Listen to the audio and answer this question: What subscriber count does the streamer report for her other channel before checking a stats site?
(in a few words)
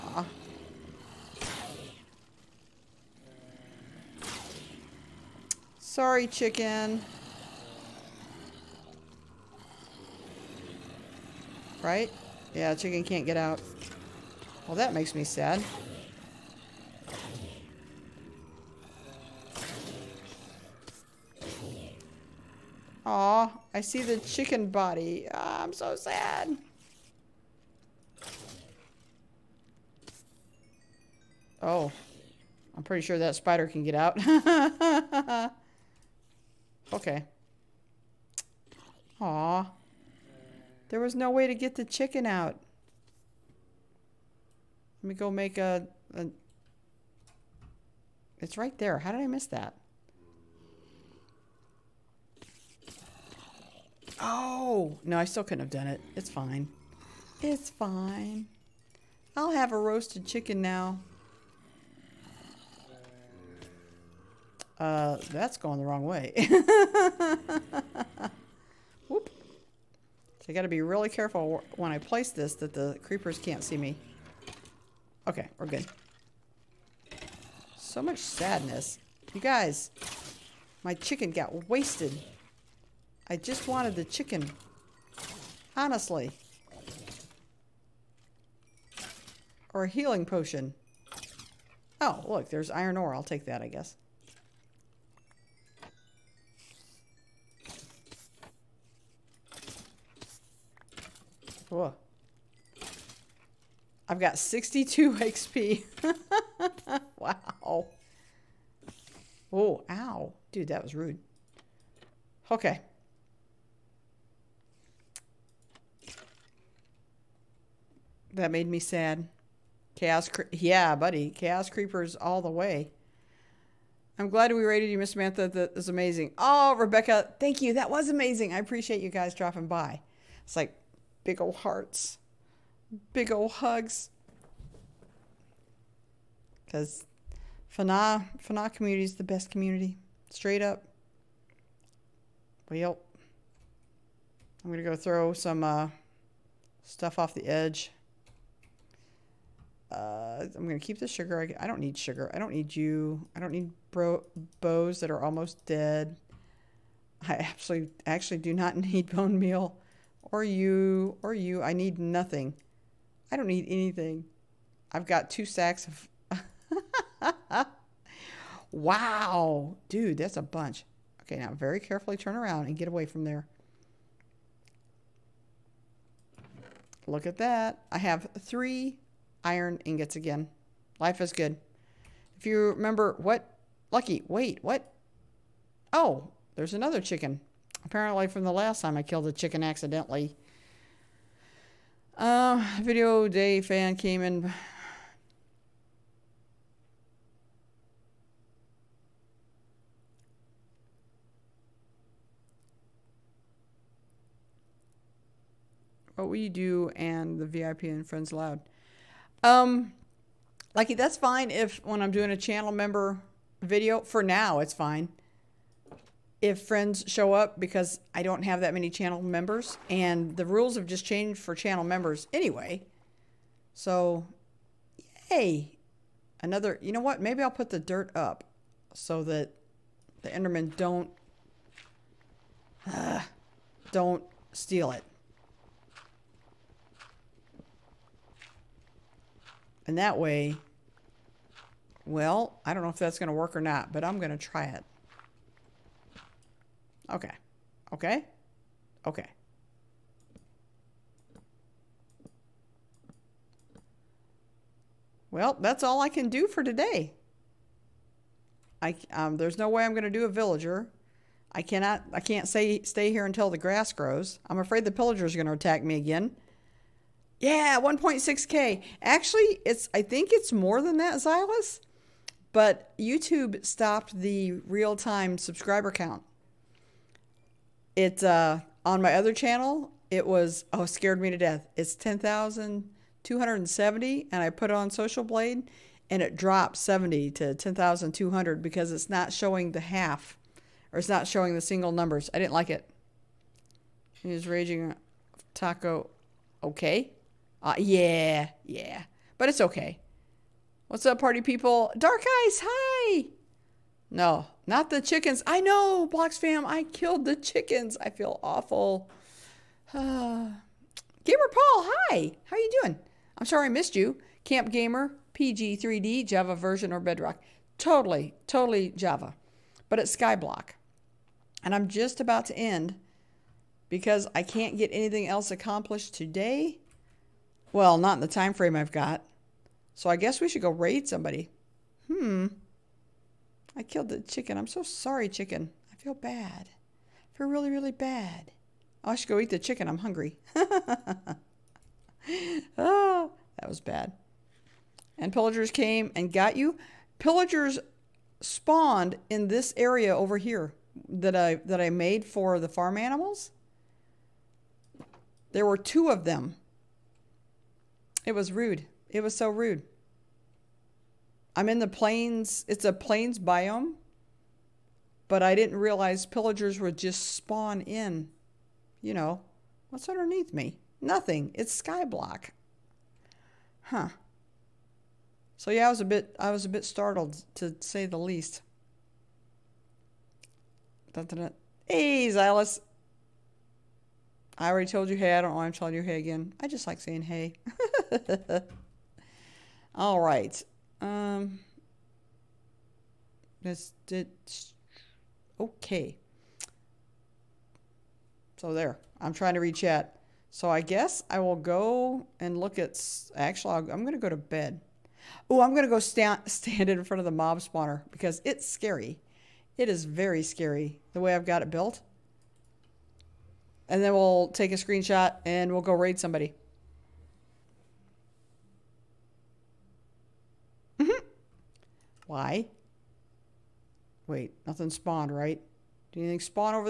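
10,270.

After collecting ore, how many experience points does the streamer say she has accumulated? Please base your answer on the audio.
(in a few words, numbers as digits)
62.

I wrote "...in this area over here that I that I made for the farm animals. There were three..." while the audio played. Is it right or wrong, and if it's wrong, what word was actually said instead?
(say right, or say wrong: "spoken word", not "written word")
wrong: "two", not "three".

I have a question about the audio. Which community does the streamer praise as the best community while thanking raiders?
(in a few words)
Fana community.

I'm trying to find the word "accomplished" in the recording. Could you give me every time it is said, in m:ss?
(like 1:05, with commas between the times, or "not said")
5:25.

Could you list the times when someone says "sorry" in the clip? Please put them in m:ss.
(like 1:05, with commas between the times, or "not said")
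0:05, 5:13, 5:34.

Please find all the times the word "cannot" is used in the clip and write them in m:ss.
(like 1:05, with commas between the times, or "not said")
4:21.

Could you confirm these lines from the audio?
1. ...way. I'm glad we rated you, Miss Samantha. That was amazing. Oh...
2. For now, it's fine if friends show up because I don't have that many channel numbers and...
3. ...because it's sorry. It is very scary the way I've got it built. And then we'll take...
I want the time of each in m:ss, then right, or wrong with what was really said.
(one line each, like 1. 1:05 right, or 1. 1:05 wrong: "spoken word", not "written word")
1. 2:02 right
2. 3:34 wrong: "members", not "numbers"
3. 6:48 wrong: "scary", not "sorry".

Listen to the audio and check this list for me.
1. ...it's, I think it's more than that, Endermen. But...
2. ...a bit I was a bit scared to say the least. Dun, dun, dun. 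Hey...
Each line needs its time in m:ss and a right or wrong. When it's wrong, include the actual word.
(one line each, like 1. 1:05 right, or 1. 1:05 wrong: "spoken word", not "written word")
1. 4:29 wrong: "Xylus", not "Endermen"
2. 6:16 wrong: "startled", not "scared".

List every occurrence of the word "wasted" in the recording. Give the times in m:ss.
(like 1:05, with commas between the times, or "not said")
1:21.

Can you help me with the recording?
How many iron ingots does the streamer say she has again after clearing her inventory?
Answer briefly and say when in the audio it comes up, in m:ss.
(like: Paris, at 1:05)
3, at 2:58.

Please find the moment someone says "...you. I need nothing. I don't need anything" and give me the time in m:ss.
2:41.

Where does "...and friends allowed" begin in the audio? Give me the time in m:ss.
3:27.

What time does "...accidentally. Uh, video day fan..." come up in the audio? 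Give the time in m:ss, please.
3:09.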